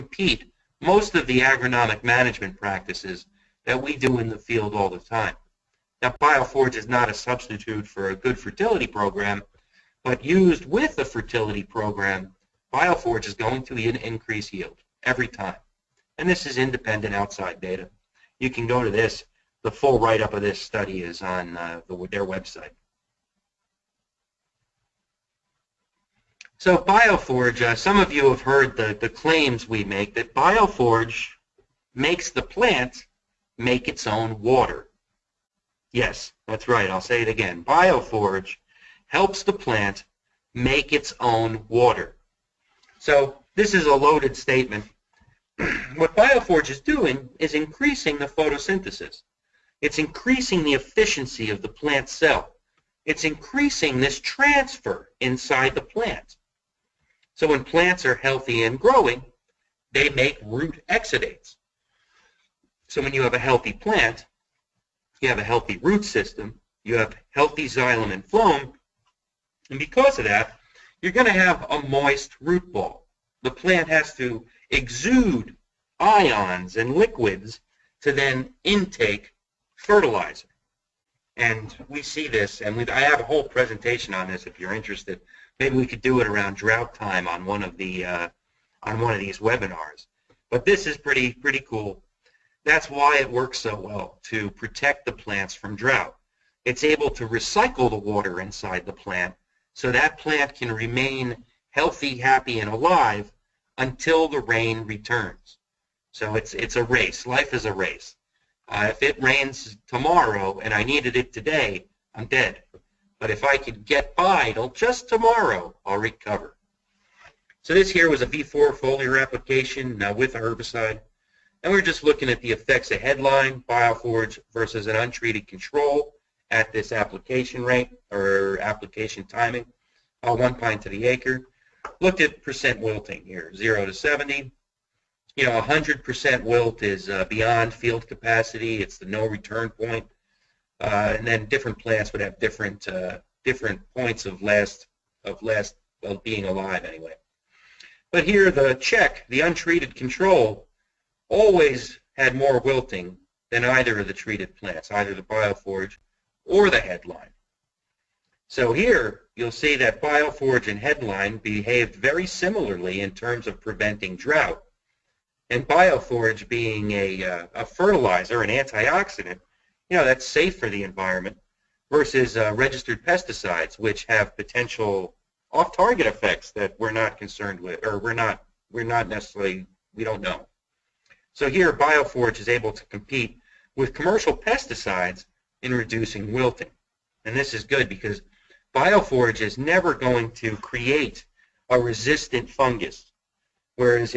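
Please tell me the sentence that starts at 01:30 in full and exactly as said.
But this is pretty pretty cool that's why it works so well to protect the plants from drought.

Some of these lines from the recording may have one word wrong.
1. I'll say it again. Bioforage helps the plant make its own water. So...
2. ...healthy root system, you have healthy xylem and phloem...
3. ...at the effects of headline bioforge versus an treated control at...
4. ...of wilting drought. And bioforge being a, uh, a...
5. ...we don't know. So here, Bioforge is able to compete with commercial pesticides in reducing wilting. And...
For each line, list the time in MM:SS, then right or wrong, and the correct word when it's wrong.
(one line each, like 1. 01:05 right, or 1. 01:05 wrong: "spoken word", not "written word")
1. 00:36 right
2. 01:05 right
3. 02:02 wrong: "untreated", not "treated"
4. 02:43 wrong: "preventing", not "wilting"
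5. 02:59 right.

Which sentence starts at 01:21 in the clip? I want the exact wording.
And we see this, and I have a whole presentation on this if you're interested.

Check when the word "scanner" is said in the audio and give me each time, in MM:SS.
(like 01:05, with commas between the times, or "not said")
not said.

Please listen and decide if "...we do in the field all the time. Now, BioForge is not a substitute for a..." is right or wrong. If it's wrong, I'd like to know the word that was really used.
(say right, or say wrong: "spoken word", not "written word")
right.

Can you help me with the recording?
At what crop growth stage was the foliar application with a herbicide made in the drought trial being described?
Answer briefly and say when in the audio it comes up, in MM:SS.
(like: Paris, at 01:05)
V4, at 01:58.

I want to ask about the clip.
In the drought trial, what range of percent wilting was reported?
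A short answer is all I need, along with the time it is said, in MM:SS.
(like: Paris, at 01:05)
0 to 70, at 02:13.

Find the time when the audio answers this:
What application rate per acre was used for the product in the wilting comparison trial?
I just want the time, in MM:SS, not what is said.
02:10.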